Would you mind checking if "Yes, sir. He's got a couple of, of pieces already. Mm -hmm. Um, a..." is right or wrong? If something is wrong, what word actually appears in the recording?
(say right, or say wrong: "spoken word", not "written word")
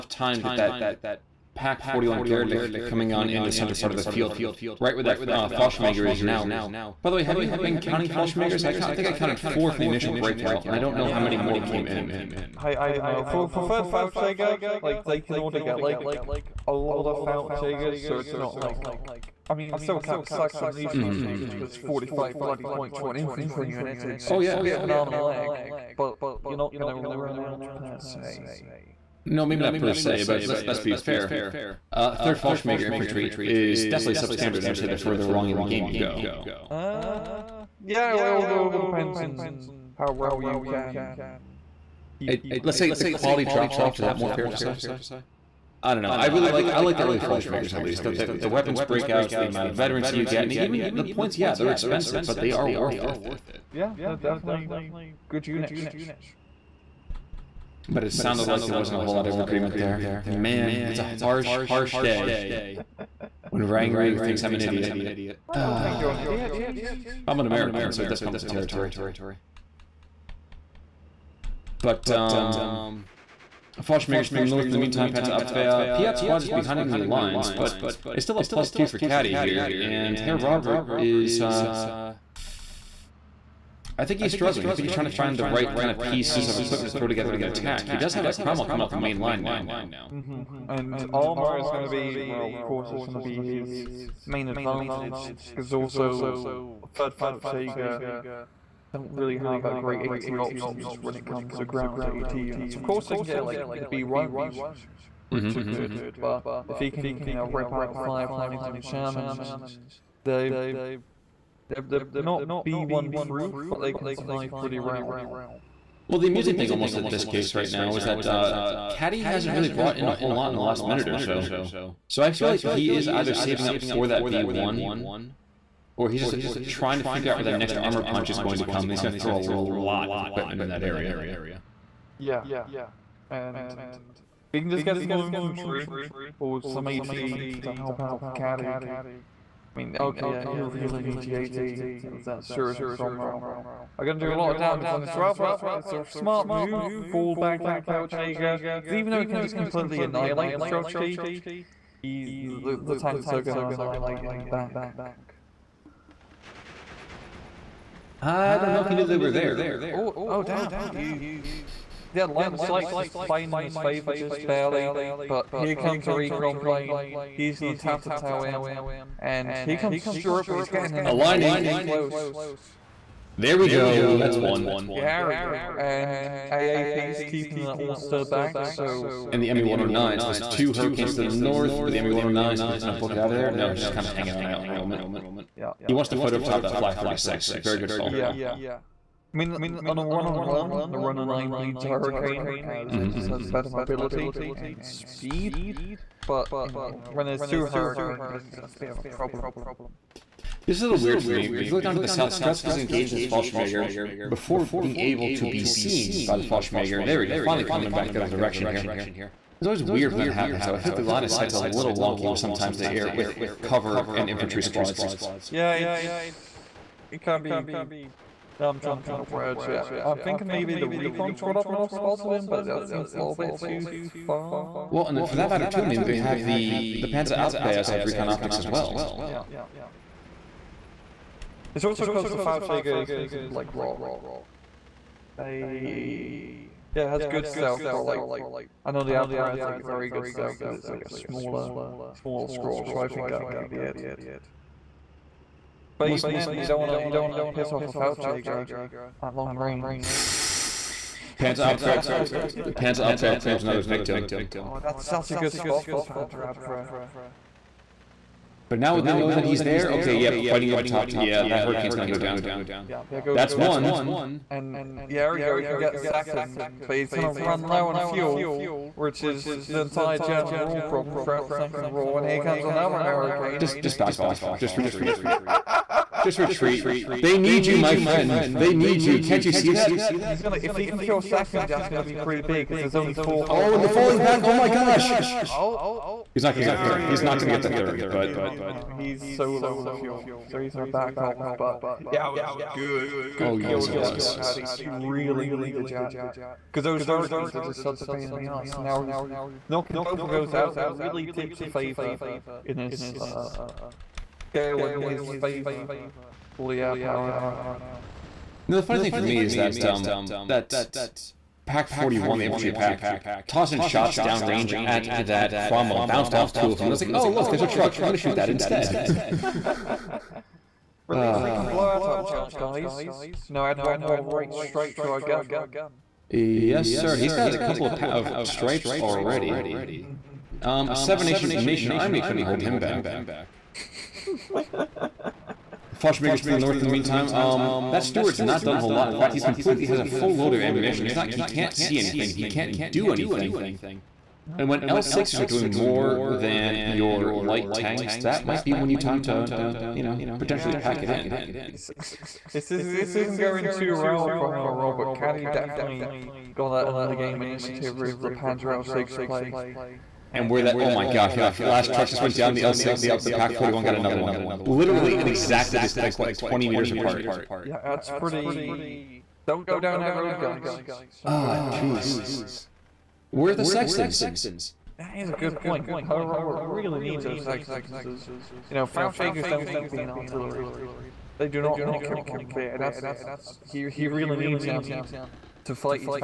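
wrong: "stripes", not "pieces".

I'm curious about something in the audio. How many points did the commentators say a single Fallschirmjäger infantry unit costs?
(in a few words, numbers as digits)
45.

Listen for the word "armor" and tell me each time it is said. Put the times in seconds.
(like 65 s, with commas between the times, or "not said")
91 s, 127 s.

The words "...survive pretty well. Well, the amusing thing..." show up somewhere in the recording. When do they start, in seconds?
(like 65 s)
114 s.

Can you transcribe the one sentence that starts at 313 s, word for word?
shots downrange at that Cromwell, bounced off two of them.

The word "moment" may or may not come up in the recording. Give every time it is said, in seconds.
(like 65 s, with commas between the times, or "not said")
184 s.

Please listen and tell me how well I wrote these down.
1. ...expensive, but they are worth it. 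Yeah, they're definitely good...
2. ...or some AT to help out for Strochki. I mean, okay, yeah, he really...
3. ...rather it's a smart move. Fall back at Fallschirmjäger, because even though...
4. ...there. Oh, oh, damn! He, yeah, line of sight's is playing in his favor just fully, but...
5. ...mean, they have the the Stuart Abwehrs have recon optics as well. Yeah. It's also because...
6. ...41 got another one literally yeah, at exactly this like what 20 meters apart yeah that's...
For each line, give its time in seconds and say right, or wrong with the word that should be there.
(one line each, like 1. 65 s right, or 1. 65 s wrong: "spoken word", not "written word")
1. 51 s right
2. 136 s wrong: "Caddy", not "Strochki"
3. 145 s wrong: "Pelchager", not "Fallschirmjäger"
4. 159 s wrong: "barely", not "fully"
5. 225 s wrong: "Panzer", not "Stuart"
6. 363 s right.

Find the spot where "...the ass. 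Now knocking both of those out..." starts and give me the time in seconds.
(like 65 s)
298 s.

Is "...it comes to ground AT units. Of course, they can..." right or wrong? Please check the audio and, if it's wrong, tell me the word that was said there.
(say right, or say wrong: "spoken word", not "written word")
right.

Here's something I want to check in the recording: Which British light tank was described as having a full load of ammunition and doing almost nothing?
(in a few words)
Stuart.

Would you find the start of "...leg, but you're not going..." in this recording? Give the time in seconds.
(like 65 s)
25 s.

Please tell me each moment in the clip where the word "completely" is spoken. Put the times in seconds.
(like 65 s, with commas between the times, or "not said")
149 s, 339 s.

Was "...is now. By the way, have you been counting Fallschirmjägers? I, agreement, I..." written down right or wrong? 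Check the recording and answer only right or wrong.
wrong.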